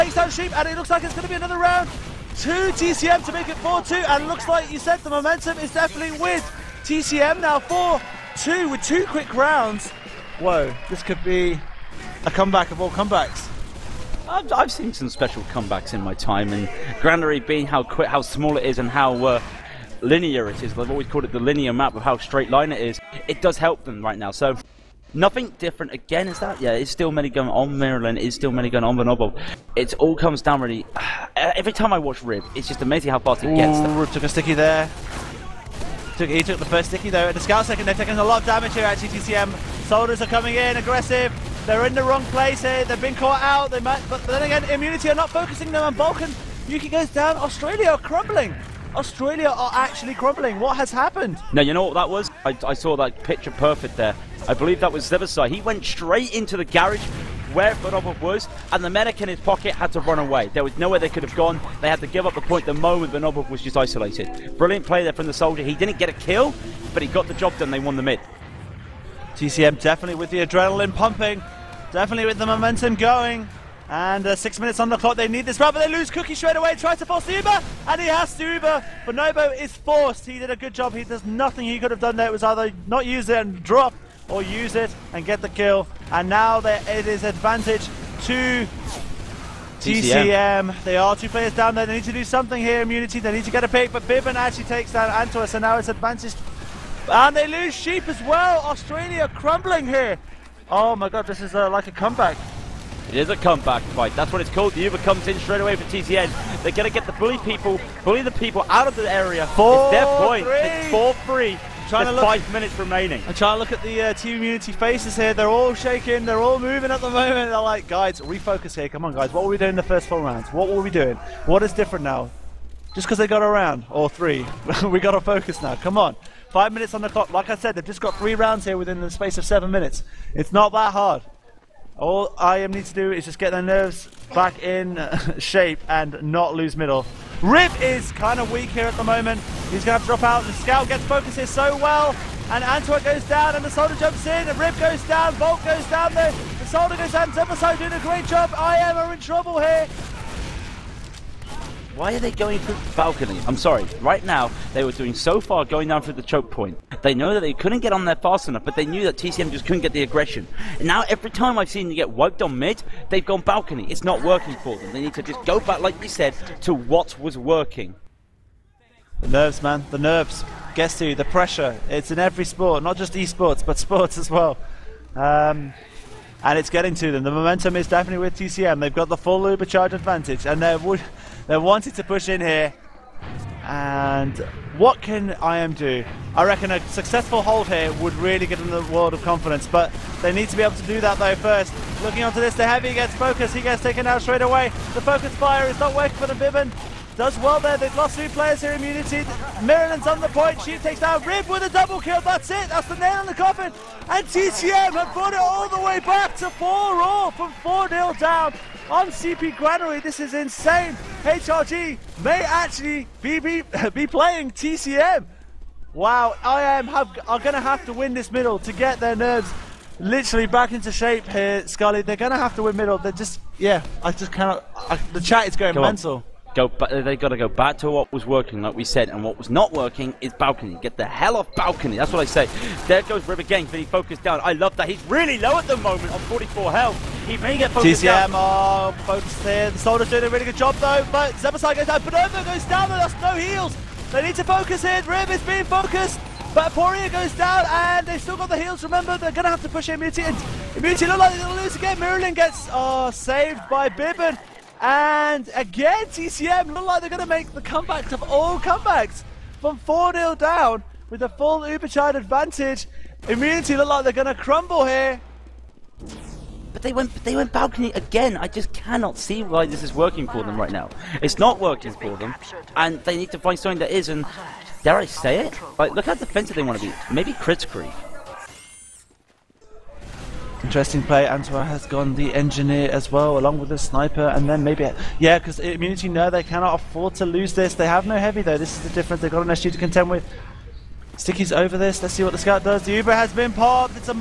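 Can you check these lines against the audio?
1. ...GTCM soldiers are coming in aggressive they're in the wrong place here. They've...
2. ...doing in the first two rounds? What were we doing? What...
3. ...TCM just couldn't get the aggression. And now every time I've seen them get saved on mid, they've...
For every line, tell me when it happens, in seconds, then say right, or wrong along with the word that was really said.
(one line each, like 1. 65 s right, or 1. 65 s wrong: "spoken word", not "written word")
1. 38 s right
2. 119 s wrong: "four", not "two"
3. 159 s wrong: "wiped", not "saved".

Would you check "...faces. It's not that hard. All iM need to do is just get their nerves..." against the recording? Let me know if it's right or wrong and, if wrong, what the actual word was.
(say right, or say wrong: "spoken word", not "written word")
wrong: "minutes", not "faces".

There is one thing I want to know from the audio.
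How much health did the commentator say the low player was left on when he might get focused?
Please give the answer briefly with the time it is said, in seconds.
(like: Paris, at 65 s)
44, at 236 s.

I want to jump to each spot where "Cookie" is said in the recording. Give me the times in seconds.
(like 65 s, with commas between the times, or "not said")
76 s.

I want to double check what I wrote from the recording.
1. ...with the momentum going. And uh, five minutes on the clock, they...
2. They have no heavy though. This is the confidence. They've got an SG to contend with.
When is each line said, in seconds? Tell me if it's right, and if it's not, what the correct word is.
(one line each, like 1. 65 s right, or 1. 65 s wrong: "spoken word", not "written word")
1. 72 s wrong: "six", not "five"
2. 287 s wrong: "difference", not "confidence".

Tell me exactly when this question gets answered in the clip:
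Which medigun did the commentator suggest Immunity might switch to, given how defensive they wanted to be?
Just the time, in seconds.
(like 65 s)
277 s.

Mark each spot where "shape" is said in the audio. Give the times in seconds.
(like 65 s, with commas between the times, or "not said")
135 s, 220 s.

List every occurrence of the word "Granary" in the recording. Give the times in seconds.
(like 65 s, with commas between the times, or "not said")
17 s, 209 s.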